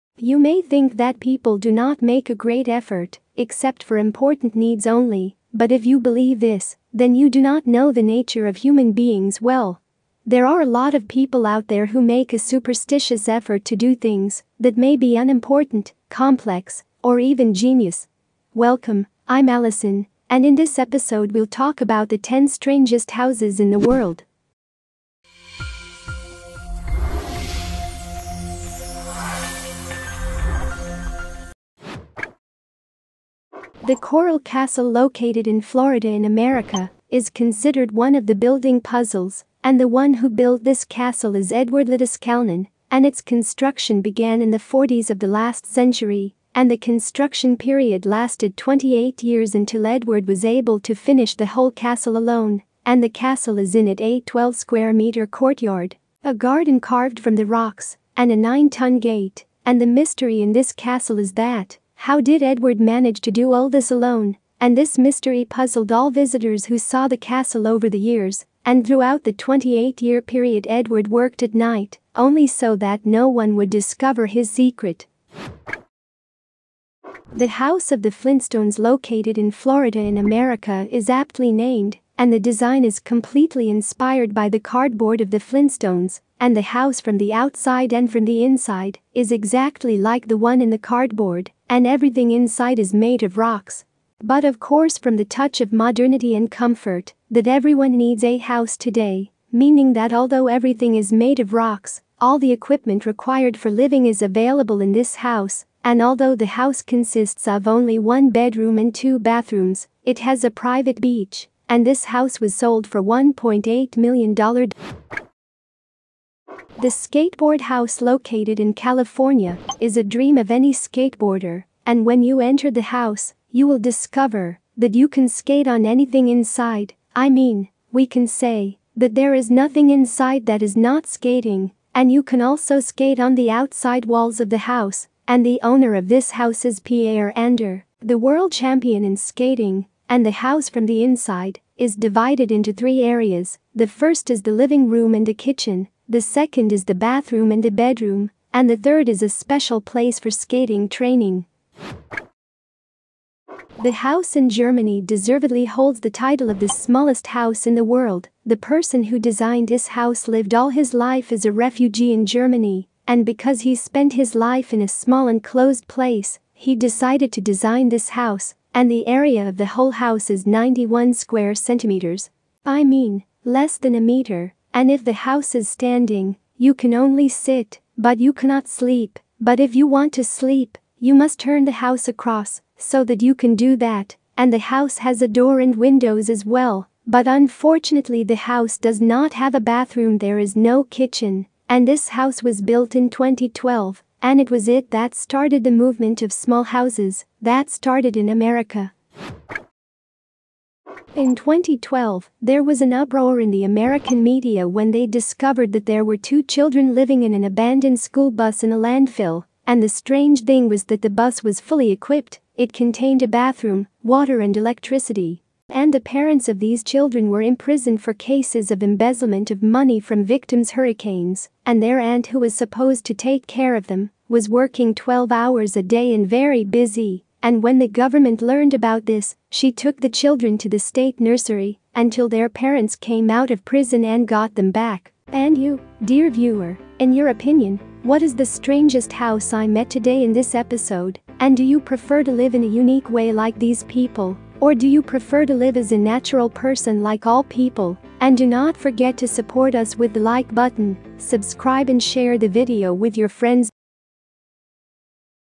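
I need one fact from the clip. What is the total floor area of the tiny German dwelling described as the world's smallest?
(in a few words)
91 square centimeters.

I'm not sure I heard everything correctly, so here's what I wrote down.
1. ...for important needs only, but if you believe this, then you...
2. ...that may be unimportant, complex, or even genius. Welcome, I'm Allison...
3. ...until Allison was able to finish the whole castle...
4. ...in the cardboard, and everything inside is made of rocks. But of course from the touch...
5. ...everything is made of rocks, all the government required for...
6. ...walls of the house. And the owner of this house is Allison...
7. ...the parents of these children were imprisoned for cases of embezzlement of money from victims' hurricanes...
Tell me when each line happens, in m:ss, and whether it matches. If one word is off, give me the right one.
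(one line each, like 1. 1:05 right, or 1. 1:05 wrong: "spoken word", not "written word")
1. 0:03 right
2. 0:14 right
3. 0:49 wrong: "Edward", not "Allison"
4. 1:30 right
5. 1:40 wrong: "equipment", not "government"
6. 2:14 wrong: "Pierre", not "Allison"
7. 3:35 right.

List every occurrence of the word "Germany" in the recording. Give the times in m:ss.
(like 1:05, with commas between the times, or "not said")
2:34, 2:42.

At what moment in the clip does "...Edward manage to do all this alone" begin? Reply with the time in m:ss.
1:02.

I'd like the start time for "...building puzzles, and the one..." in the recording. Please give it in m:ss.
0:38.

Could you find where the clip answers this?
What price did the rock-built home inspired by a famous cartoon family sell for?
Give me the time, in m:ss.
1:53.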